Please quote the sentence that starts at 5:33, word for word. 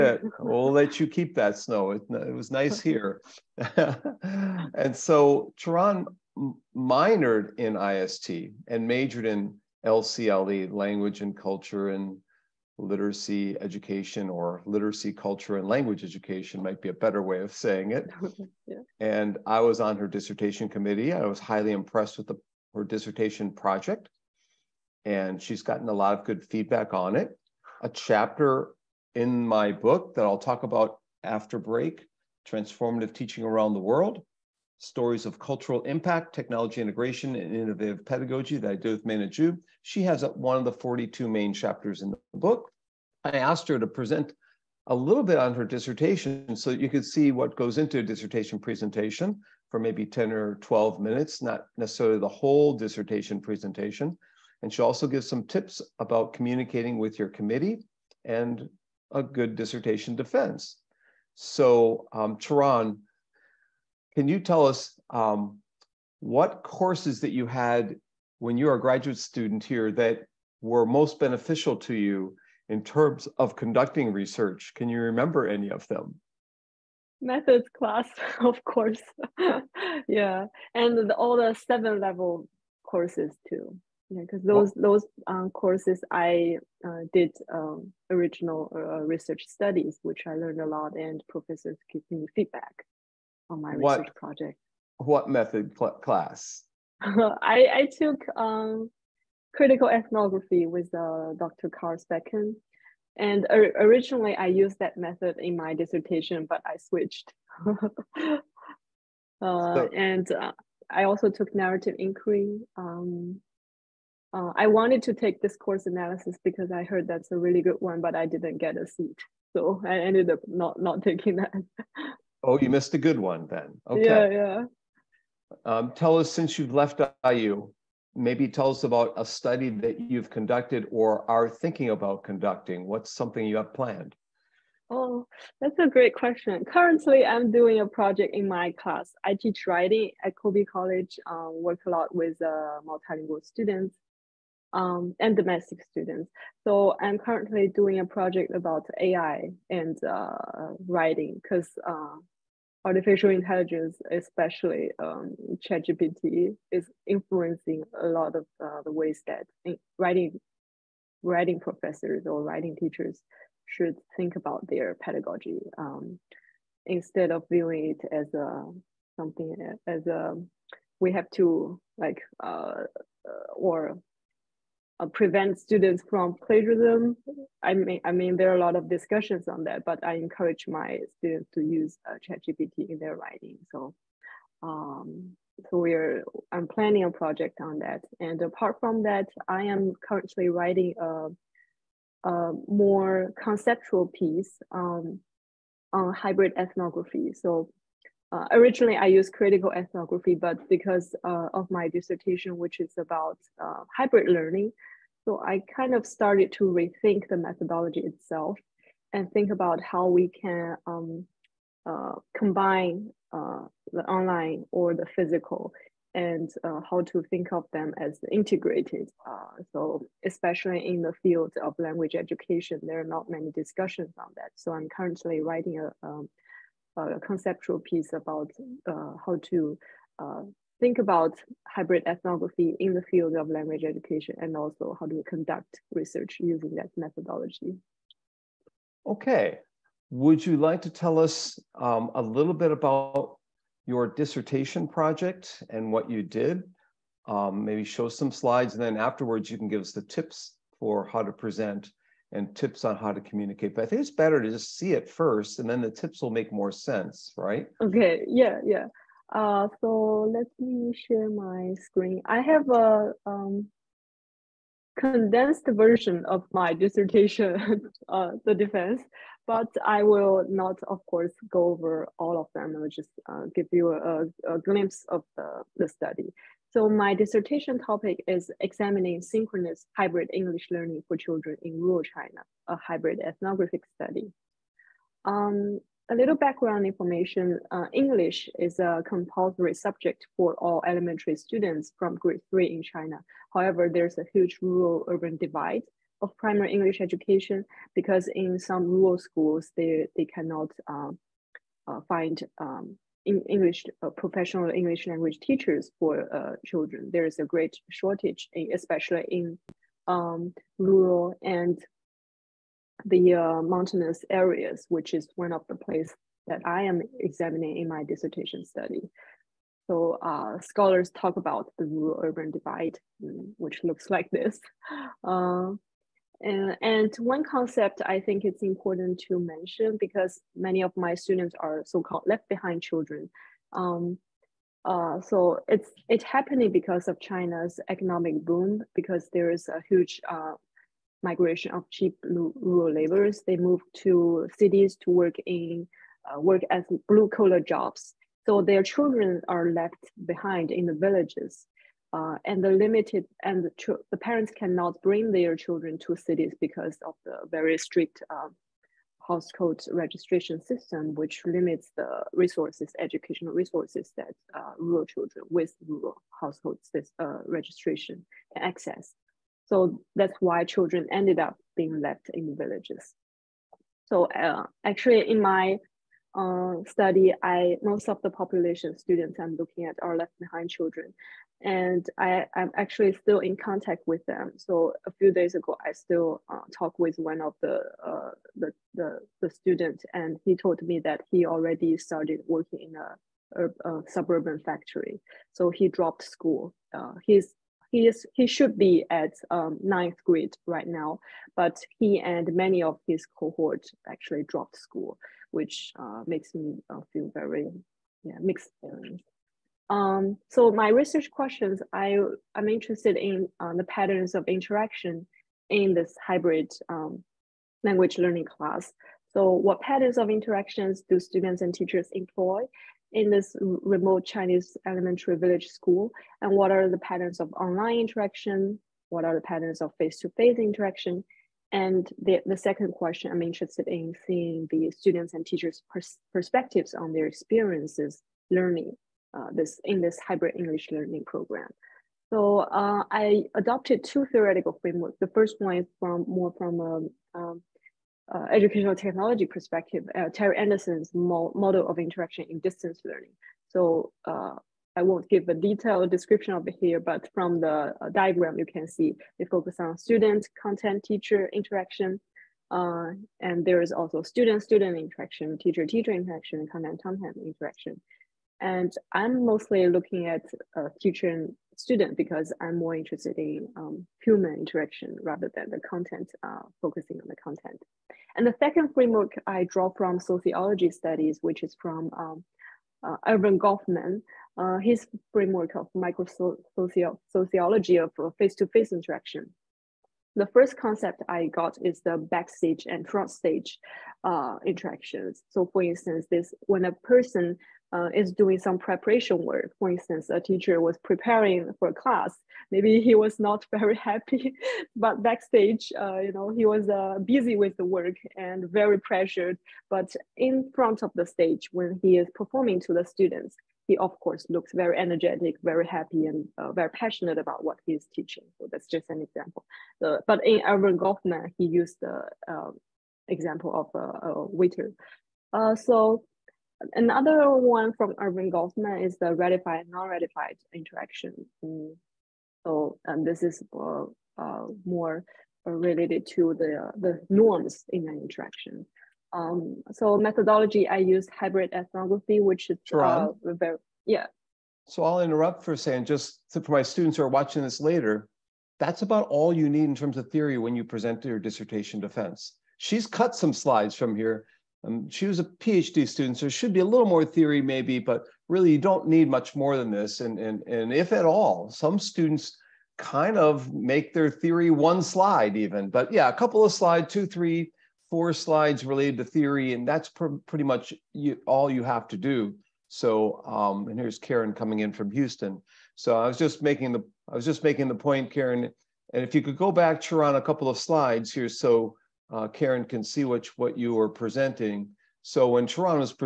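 Um, uh, so it's it's happening because of China's economic boom because there is a huge uh, migration of cheap rural laborers.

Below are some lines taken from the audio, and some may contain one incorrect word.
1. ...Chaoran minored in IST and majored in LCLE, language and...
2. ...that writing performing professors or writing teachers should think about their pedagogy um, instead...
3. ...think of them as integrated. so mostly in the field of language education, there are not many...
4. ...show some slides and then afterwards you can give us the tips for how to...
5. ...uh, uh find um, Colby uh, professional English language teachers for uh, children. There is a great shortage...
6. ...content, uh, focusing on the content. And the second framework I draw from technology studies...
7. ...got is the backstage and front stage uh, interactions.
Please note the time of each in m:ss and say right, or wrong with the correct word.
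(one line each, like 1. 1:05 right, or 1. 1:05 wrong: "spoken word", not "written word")
1. 0:05 right
2. 2:39 wrong: "writing", not "performing"
3. 3:37 wrong: "especially", not "mostly"
4. 4:07 right
5. 5:00 wrong: "English", not "Colby"
6. 7:55 wrong: "sociology", not "technology"
7. 8:11 right.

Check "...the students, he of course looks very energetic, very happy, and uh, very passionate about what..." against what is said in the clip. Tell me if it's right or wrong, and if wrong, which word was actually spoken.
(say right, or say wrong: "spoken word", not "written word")
right.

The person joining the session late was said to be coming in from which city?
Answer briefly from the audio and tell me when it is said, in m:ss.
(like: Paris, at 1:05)
Houston, at 9:35.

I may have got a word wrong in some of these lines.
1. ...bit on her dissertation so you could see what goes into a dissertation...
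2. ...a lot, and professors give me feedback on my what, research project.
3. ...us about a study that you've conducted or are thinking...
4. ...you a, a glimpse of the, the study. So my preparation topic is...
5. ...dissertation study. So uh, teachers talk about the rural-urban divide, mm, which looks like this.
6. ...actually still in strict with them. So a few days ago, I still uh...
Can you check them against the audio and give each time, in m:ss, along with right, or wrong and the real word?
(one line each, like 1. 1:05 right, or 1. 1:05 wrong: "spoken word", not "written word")
1. 0:45 right
2. 1:30 right
3. 2:08 right
4. 4:33 wrong: "dissertation", not "preparation"
5. 5:18 wrong: "scholars", not "teachers"
6. 6:22 wrong: "contact", not "strict".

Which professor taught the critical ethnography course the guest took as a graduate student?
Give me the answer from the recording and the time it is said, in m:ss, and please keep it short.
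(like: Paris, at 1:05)
Dr. Carspecken, at 1:41.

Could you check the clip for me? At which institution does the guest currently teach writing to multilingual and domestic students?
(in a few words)
Colby College.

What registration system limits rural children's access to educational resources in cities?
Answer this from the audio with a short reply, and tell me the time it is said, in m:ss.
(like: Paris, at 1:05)
household registration system, at 5:59.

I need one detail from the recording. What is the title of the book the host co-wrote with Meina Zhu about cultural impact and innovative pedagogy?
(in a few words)
Transformative Teaching Around the World.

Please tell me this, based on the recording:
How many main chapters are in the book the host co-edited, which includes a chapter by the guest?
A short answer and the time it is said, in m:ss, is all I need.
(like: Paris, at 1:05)
42, at 0:40.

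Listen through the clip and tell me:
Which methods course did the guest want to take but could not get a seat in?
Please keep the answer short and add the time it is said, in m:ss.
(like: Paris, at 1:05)
discourse analysis, at 1:55.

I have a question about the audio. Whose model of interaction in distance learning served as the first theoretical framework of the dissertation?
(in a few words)
Terry Anderson.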